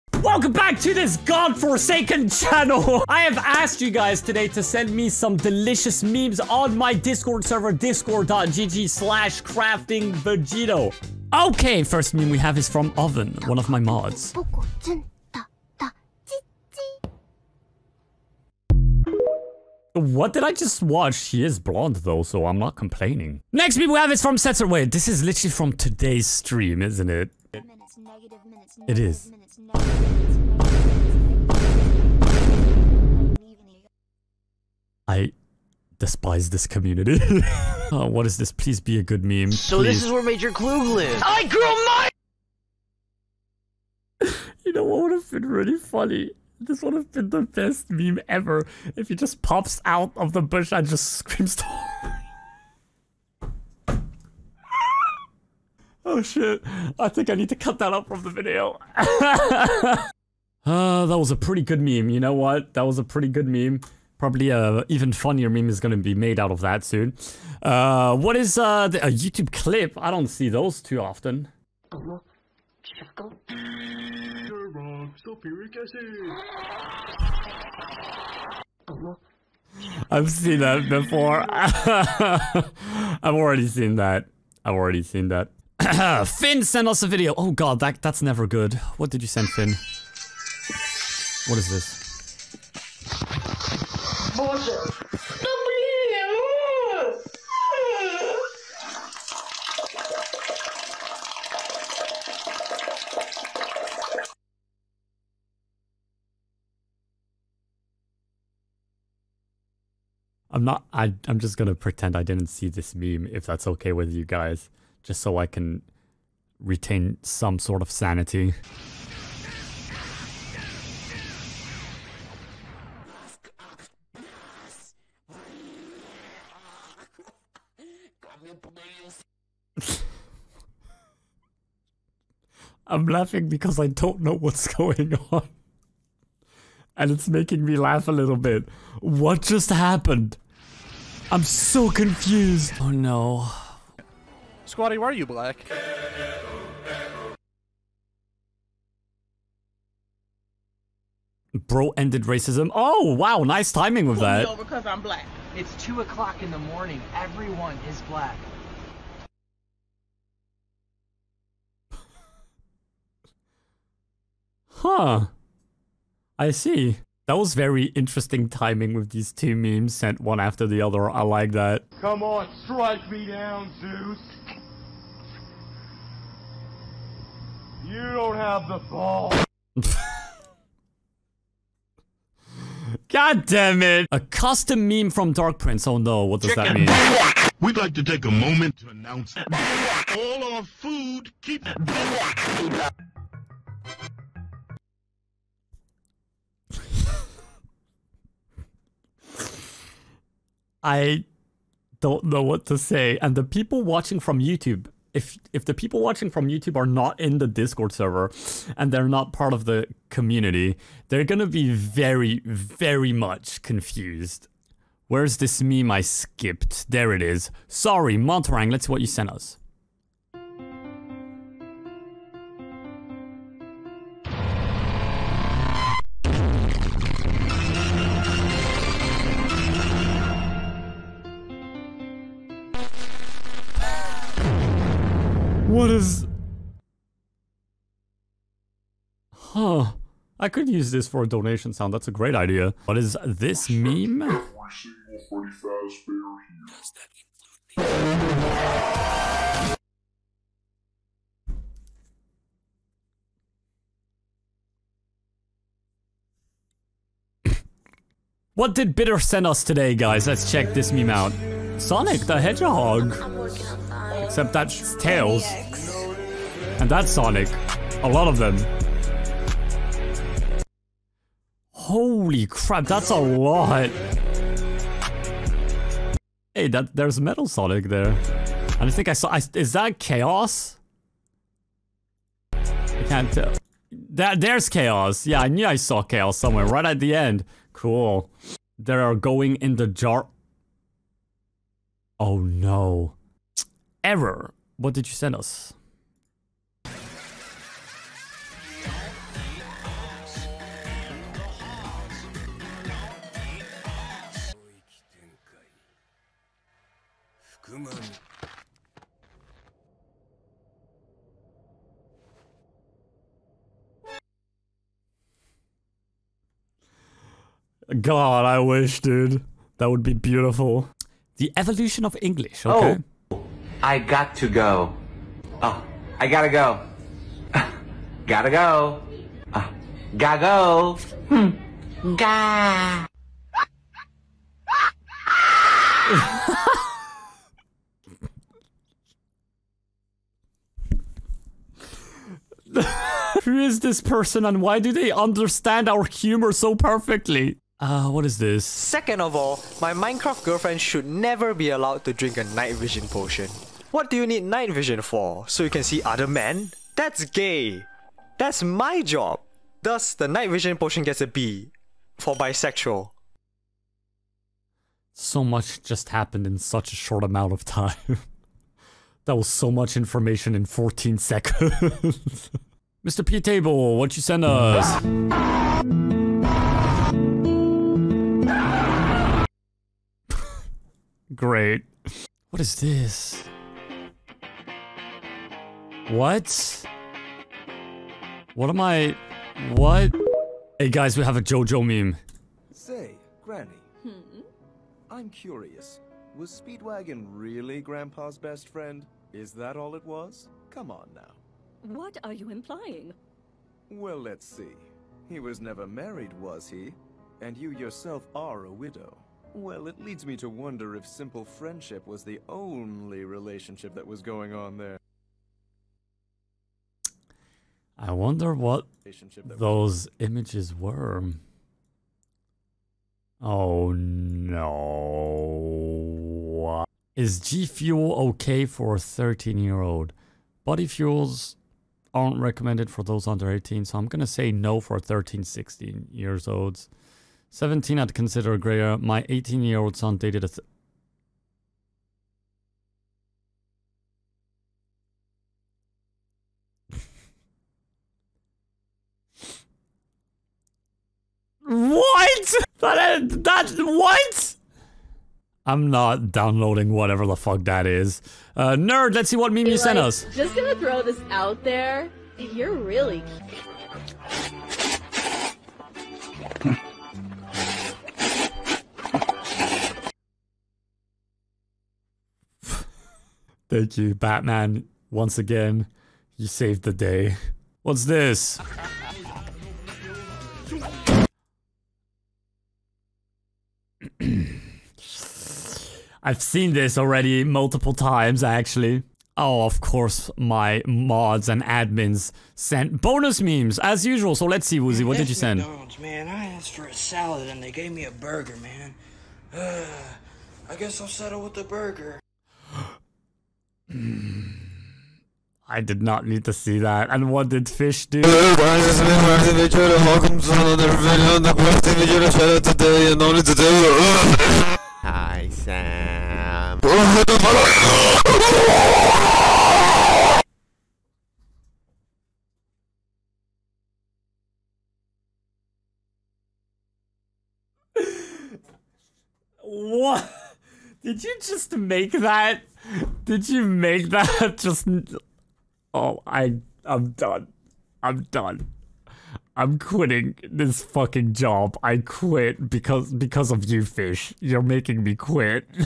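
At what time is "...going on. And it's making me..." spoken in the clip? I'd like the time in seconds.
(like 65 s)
134 s.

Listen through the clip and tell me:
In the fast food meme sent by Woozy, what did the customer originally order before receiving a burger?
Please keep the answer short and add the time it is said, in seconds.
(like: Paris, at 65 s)
A salad, at 496 s.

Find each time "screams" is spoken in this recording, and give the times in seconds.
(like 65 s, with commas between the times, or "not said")
51 s.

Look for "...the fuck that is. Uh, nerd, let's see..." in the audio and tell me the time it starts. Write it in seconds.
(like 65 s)
457 s.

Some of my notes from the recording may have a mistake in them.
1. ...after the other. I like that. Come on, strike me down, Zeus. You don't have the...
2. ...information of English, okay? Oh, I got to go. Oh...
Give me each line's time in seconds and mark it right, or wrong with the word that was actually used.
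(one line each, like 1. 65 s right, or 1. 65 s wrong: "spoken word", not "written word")
1. 170 s right
2. 321 s wrong: "evolution", not "information".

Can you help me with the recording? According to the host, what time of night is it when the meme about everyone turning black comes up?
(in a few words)
2 o'clock in the morning.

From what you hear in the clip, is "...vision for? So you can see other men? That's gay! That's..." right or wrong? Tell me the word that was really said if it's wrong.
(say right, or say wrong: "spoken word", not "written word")
right.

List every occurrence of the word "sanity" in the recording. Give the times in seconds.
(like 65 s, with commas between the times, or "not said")
117 s.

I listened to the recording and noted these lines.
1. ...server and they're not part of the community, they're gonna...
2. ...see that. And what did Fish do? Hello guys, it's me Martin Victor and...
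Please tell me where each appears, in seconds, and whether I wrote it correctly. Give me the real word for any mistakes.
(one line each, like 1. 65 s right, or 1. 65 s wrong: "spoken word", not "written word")
1. 207 s right
2. 506 s right.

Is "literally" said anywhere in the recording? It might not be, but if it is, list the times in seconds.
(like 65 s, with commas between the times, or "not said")
25 s.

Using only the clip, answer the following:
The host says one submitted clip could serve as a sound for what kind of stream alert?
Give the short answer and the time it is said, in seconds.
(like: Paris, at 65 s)
Donation sound, at 241 s.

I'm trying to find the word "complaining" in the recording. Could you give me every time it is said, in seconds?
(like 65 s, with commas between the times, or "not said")
22 s.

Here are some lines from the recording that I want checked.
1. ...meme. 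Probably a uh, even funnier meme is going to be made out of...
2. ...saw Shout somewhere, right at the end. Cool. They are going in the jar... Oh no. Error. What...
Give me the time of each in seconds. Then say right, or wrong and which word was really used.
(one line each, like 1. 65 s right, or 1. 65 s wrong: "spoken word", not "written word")
1. 63 s right
2. 285 s wrong: "Chaos", not "Shout".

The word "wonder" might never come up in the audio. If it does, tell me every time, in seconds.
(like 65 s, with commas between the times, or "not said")
410 s, 418 s.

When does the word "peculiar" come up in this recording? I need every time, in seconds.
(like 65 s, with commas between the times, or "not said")
not said.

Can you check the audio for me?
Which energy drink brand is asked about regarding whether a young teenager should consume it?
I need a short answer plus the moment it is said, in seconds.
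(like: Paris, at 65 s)
G Fuel, at 427 s.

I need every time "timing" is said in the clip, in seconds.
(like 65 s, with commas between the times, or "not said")
153 s, 168 s.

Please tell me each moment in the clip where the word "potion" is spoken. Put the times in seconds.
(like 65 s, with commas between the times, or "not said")
353 s, 360 s.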